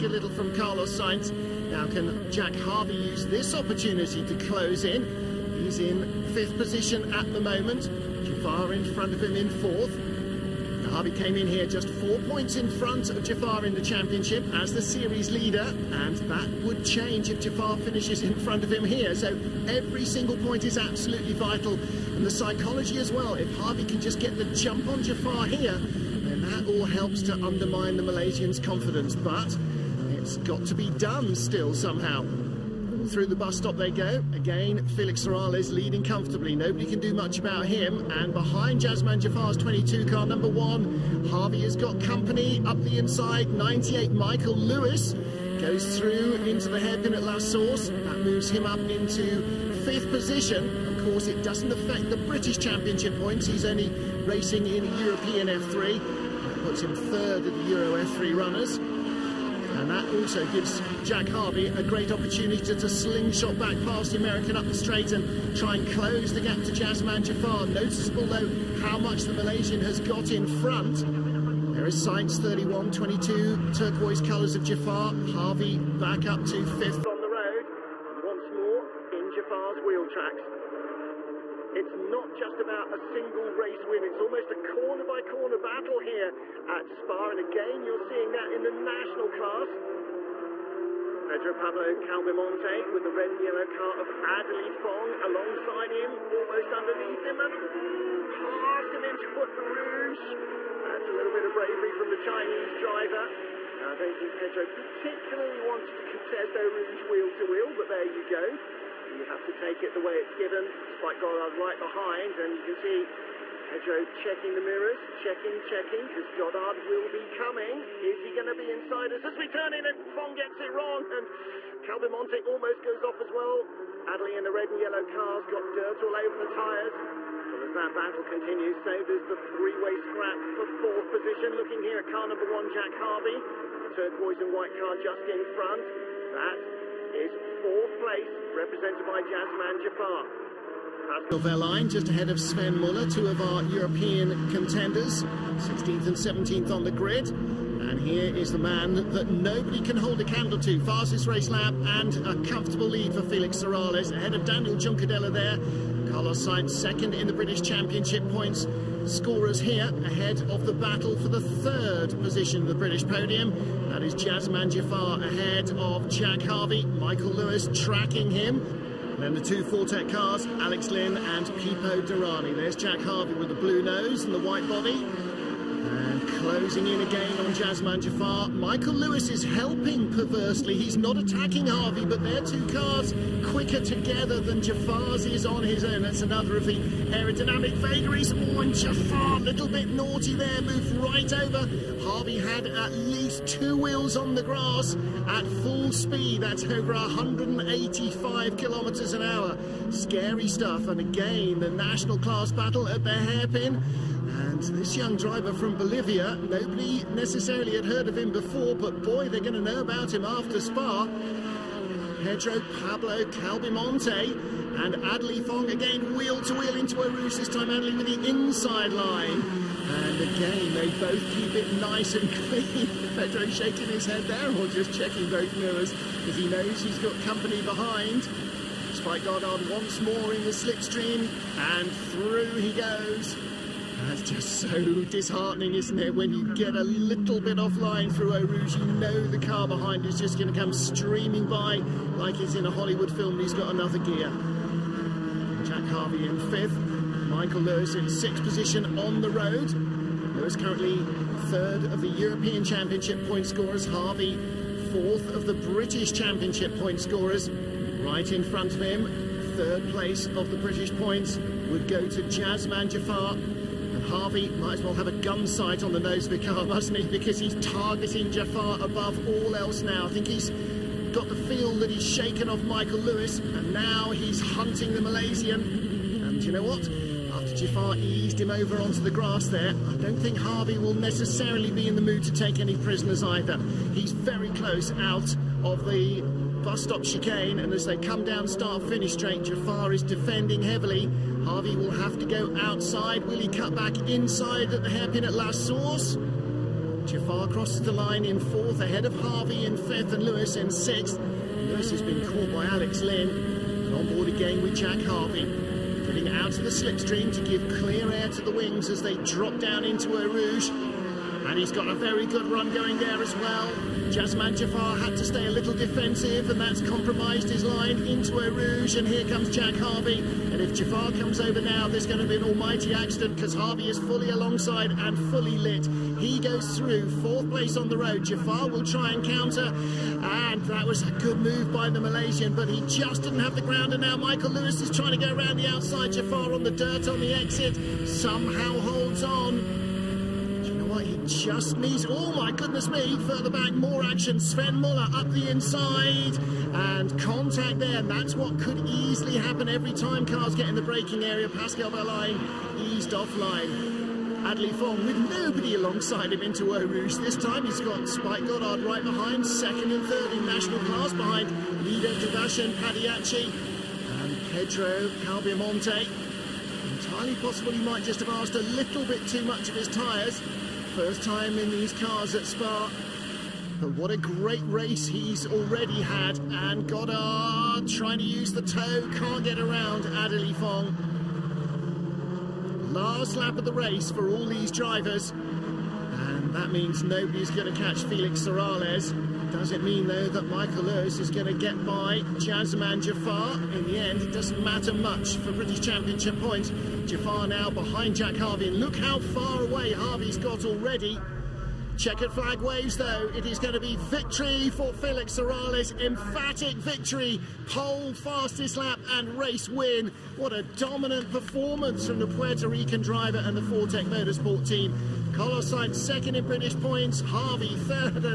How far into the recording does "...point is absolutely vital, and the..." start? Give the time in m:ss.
0:20.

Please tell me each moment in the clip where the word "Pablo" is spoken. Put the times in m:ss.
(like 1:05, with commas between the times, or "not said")
1:31, 3:32.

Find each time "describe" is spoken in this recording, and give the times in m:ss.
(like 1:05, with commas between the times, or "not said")
not said.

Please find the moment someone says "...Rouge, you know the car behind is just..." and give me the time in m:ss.
3:58.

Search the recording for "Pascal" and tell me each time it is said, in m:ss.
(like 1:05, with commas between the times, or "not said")
2:21, 5:51.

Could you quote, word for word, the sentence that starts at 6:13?
But what a great race he's already had.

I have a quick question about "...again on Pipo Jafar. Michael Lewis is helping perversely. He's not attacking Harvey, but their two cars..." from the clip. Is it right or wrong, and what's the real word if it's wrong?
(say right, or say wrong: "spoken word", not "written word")
wrong: "Jazeman", not "Pipo".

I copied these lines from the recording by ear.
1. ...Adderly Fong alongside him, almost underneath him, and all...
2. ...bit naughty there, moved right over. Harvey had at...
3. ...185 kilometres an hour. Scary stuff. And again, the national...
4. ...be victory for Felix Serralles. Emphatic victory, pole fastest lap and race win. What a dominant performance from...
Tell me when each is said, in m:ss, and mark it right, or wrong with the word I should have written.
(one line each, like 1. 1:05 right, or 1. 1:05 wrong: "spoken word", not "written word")
1. 1:34 right
2. 3:09 right
3. 3:16 right
4. 6:43 right.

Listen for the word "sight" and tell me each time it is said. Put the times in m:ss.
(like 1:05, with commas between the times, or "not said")
4:25.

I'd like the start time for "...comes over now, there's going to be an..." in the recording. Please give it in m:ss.
5:21.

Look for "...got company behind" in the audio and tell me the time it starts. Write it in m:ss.
3:46.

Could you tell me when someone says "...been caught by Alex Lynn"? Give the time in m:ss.
5:02.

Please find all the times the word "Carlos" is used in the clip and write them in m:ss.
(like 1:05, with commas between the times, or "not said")
0:00, 2:36, 6:55.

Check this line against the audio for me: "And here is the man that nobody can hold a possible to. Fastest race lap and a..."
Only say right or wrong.
wrong.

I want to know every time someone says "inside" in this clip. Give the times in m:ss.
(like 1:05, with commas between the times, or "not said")
0:42, 1:58, 3:38, 4:54, 5:45.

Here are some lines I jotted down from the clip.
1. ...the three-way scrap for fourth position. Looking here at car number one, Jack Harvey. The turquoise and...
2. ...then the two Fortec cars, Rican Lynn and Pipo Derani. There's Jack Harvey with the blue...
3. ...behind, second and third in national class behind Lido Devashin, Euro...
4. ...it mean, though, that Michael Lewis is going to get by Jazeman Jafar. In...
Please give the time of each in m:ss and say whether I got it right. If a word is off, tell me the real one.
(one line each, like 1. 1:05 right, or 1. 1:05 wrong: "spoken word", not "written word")
1. 2:09 right
2. 2:49 wrong: "Alex", not "Rican"
3. 5:59 wrong: "Padayachee", not "Euro"
4. 6:29 right.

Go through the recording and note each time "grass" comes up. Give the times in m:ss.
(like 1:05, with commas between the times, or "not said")
3:14, 4:39.